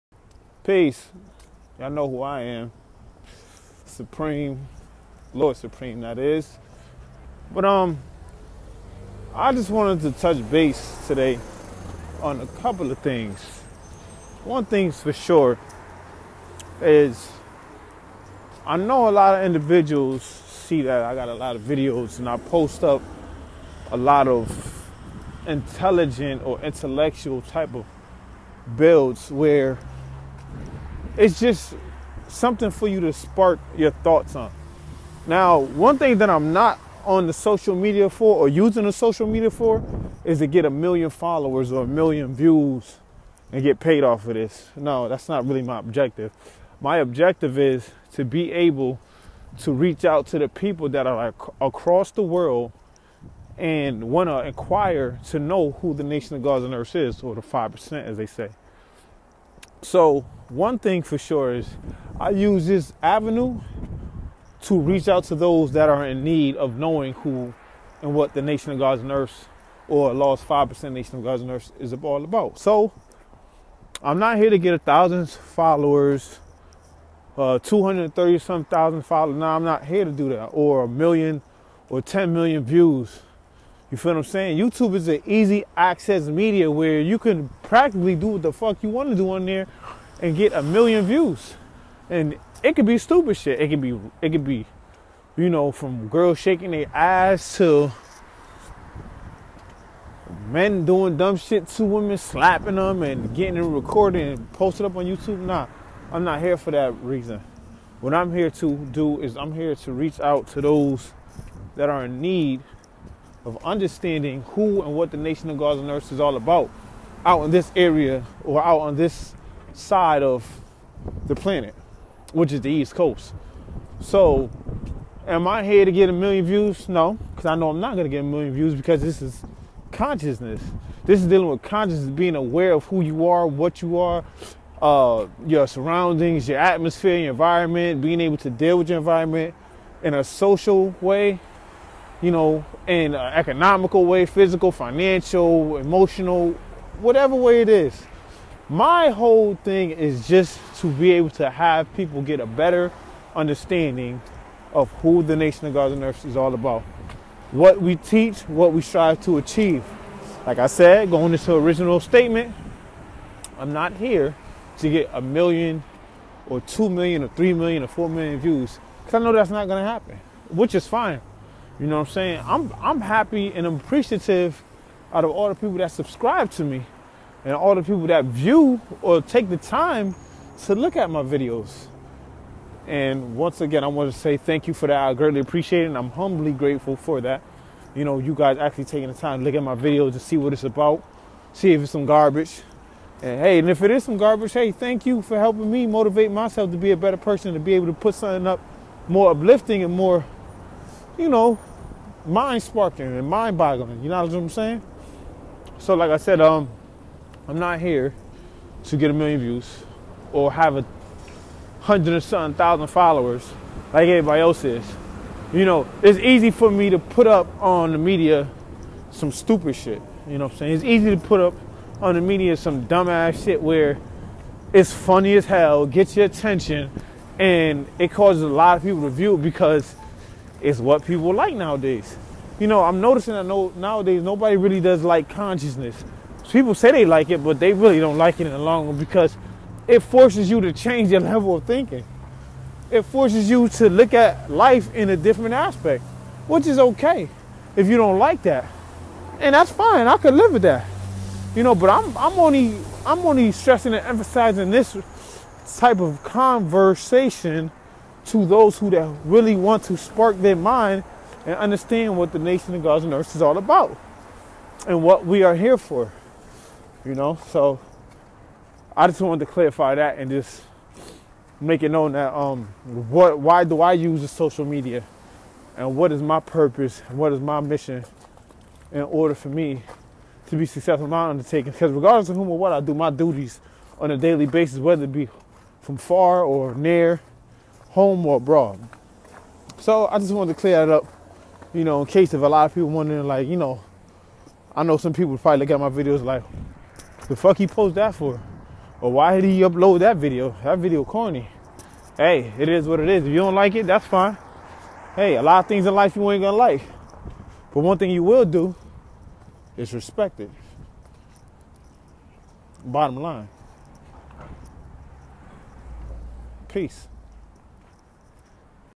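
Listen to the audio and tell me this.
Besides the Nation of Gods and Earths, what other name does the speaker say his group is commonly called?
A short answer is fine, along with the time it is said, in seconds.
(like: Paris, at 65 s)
the 5%, at 57 s.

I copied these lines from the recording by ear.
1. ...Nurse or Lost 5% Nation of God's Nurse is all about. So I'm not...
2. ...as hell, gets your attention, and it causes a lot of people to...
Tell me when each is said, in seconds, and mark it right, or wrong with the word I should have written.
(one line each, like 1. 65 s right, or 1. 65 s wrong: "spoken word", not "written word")
1. 69 s right
2. 225 s right.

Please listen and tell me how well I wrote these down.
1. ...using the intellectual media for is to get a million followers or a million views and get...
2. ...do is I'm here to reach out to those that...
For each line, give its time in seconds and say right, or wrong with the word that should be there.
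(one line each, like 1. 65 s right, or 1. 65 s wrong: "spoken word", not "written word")
1. 38 s wrong: "social", not "intellectual"
2. 108 s right.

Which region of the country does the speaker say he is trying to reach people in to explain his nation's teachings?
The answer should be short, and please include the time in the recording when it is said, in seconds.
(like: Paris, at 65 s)
East Coast, at 122 s.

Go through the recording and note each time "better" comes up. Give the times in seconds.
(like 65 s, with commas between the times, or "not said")
152 s, 196 s.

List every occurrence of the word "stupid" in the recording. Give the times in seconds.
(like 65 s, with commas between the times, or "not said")
92 s, 219 s.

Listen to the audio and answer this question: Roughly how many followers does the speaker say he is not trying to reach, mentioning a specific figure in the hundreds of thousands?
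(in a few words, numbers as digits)
230 some thousand.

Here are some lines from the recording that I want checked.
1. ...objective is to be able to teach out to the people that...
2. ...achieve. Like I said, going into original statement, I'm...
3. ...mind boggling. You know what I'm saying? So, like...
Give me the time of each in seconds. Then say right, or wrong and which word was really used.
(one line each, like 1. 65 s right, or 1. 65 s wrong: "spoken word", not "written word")
1. 46 s wrong: "reach", not "teach"
2. 159 s right
3. 203 s right.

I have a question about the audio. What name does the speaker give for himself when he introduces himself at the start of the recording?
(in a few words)
Lord Supreme.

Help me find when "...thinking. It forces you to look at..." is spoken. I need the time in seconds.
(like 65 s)
241 s.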